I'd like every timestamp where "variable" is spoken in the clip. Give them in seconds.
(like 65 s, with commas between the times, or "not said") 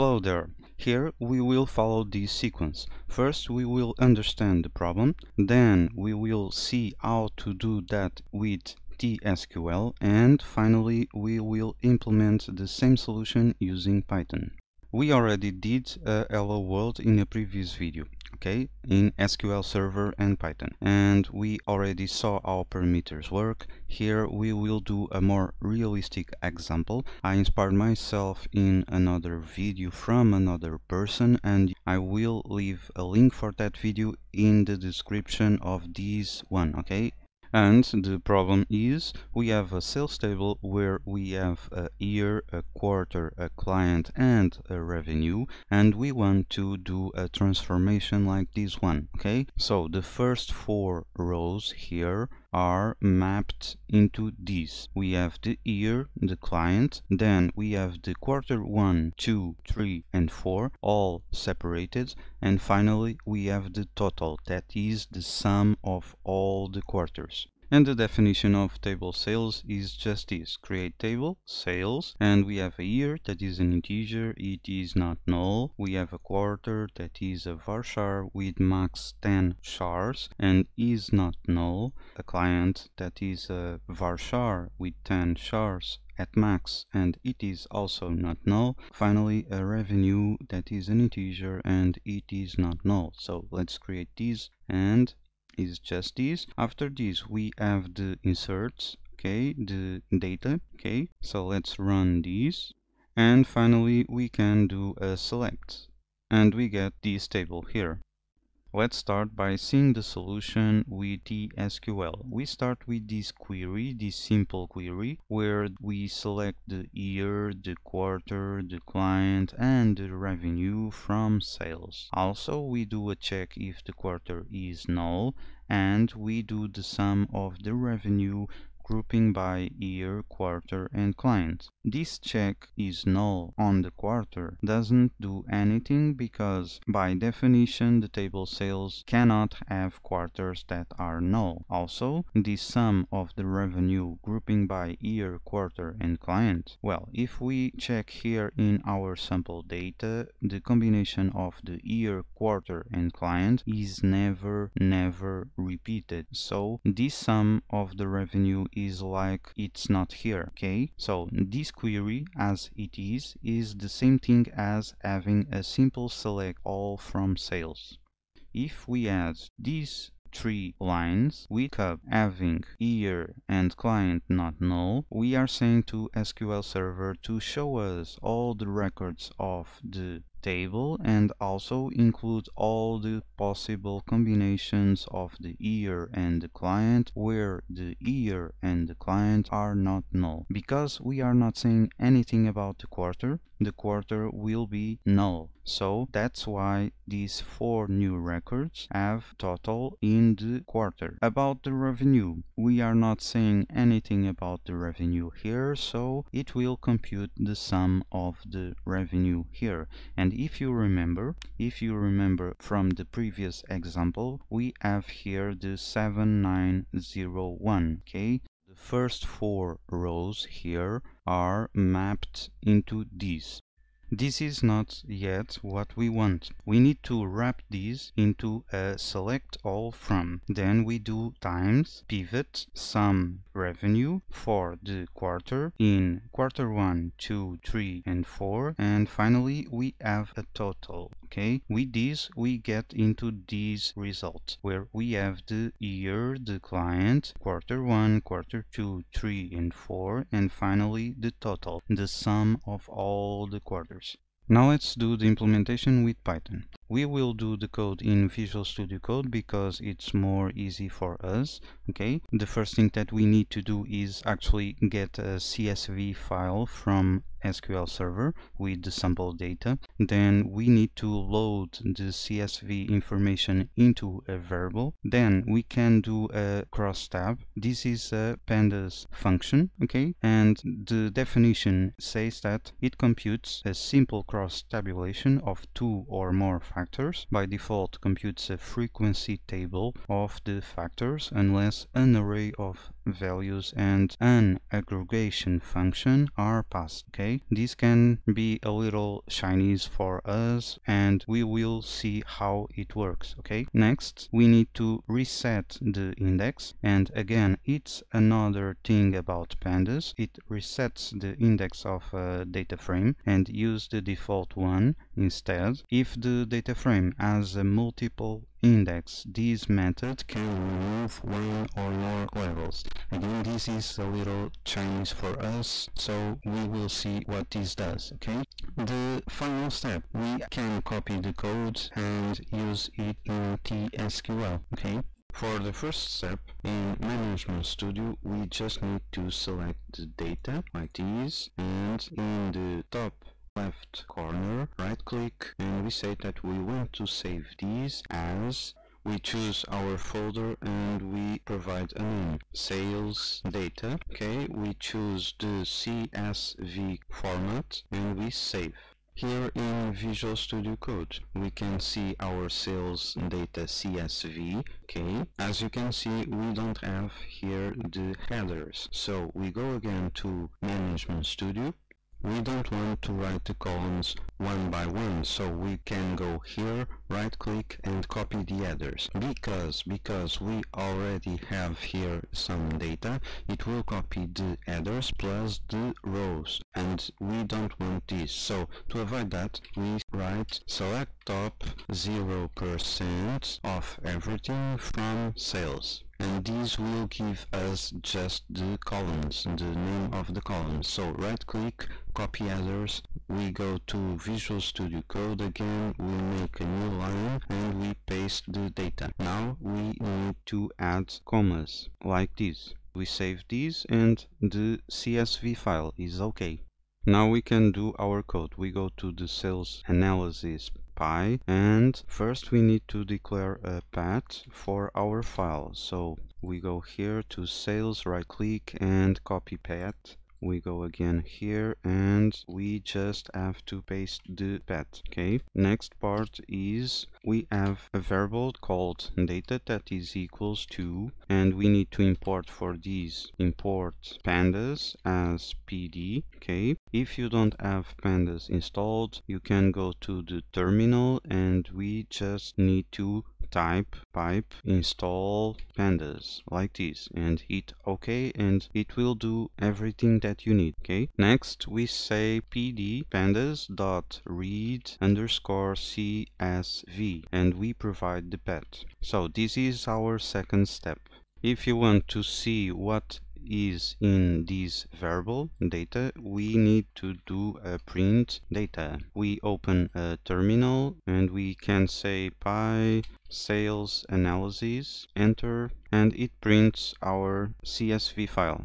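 274 s, 437 s, 474 s.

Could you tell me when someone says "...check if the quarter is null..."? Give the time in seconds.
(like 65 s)
123 s.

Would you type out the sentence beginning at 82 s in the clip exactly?
A client that is a varchar with 10 chars at max and it is also not null.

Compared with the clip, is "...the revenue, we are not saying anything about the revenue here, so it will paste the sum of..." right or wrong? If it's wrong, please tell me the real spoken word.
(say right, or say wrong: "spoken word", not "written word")
wrong: "compute", not "paste".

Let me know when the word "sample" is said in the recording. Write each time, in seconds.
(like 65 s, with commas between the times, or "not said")
149 s, 268 s.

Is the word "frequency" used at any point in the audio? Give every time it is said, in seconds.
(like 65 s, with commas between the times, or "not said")
288 s.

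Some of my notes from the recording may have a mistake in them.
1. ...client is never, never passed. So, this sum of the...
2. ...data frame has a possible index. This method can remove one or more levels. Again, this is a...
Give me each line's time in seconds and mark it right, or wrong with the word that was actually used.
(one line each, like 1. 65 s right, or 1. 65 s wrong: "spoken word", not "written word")
1. 153 s wrong: "repeated", not "passed"
2. 316 s wrong: "multiple", not "possible".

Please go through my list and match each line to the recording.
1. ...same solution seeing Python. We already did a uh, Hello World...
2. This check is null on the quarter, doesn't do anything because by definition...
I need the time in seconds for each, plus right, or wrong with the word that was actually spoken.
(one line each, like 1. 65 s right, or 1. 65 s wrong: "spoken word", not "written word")
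1. 12 s wrong: "using", not "seeing"
2. 131 s right.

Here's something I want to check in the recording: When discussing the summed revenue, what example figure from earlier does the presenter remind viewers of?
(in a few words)
7901.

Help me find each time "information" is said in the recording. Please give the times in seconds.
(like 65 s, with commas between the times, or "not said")
272 s.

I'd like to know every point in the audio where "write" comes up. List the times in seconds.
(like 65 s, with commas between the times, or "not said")
373 s, 390 s.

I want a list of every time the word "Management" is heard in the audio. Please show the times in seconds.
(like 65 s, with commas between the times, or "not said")
336 s, 370 s.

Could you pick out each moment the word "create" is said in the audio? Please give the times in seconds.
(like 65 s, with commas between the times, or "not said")
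70 s, 93 s.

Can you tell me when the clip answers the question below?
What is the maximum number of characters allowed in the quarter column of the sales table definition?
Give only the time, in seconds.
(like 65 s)
78 s.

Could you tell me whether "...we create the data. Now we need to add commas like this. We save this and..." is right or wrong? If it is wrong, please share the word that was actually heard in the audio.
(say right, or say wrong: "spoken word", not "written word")
wrong: "paste", not "create".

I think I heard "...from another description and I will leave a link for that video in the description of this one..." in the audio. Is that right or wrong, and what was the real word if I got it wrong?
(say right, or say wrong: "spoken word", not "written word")
wrong: "person", not "description".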